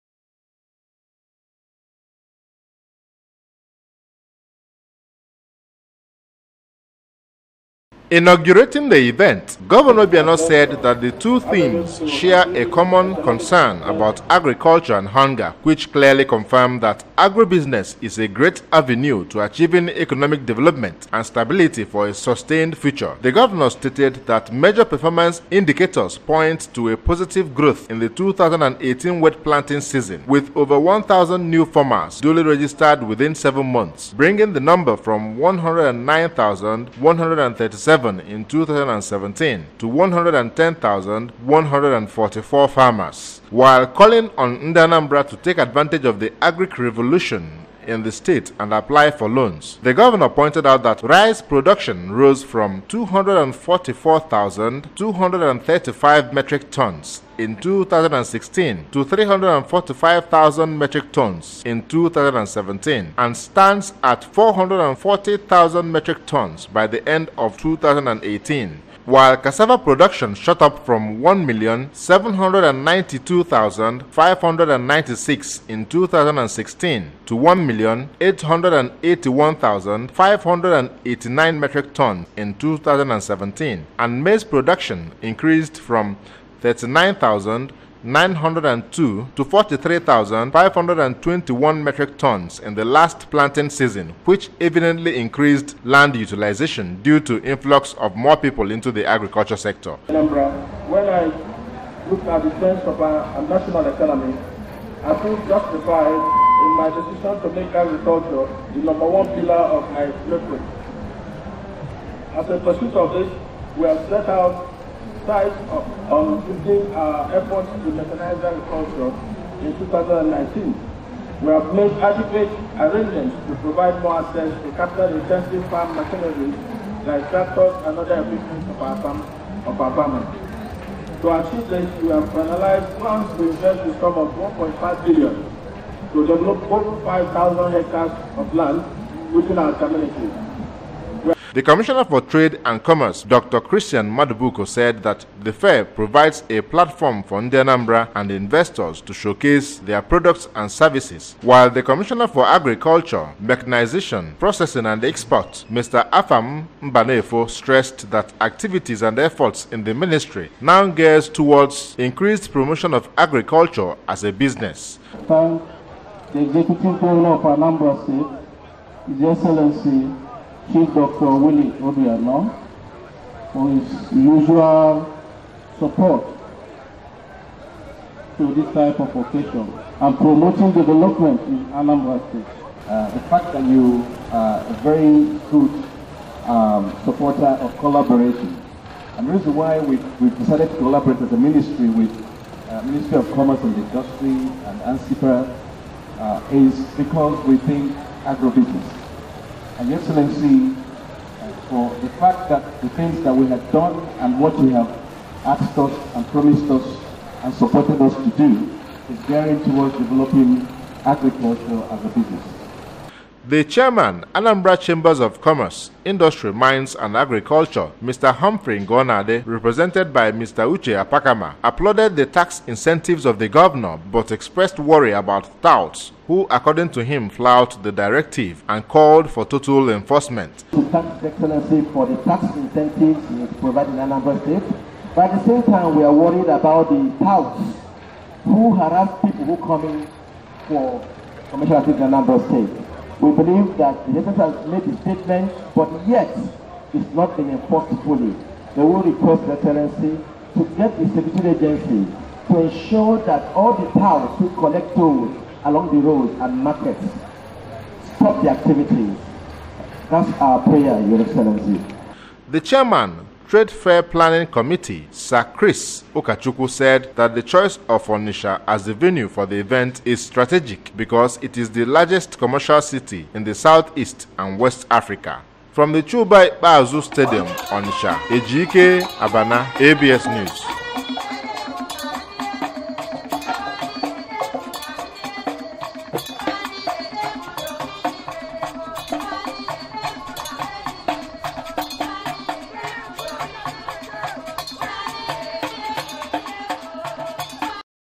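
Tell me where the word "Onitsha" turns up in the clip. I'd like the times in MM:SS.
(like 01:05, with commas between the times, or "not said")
04:28, 04:37.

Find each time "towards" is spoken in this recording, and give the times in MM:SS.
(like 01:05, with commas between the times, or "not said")
02:41, 03:29.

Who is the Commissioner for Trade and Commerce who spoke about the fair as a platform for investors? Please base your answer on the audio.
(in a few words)
Christian Madubuko.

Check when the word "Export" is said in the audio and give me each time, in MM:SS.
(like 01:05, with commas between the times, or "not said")
02:35.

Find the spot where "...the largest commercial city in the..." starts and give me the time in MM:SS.
04:31.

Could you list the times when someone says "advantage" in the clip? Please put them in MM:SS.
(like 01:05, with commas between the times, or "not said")
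00:45.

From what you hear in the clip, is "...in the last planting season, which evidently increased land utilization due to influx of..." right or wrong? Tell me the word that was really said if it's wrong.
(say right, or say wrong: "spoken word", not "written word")
right.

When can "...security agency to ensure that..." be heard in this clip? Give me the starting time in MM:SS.
04:11.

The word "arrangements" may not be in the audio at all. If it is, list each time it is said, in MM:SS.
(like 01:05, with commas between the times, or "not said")
02:02.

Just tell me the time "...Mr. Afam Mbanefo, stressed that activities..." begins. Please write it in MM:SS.
02:35.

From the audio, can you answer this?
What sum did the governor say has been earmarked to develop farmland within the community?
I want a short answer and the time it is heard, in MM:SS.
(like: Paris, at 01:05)
1.5 billion, at 02:14.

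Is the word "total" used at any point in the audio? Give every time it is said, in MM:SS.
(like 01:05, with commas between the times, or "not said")
03:49.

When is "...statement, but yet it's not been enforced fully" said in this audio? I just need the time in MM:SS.
04:05.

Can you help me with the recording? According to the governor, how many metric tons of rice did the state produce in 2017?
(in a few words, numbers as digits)
345,000 metric tons.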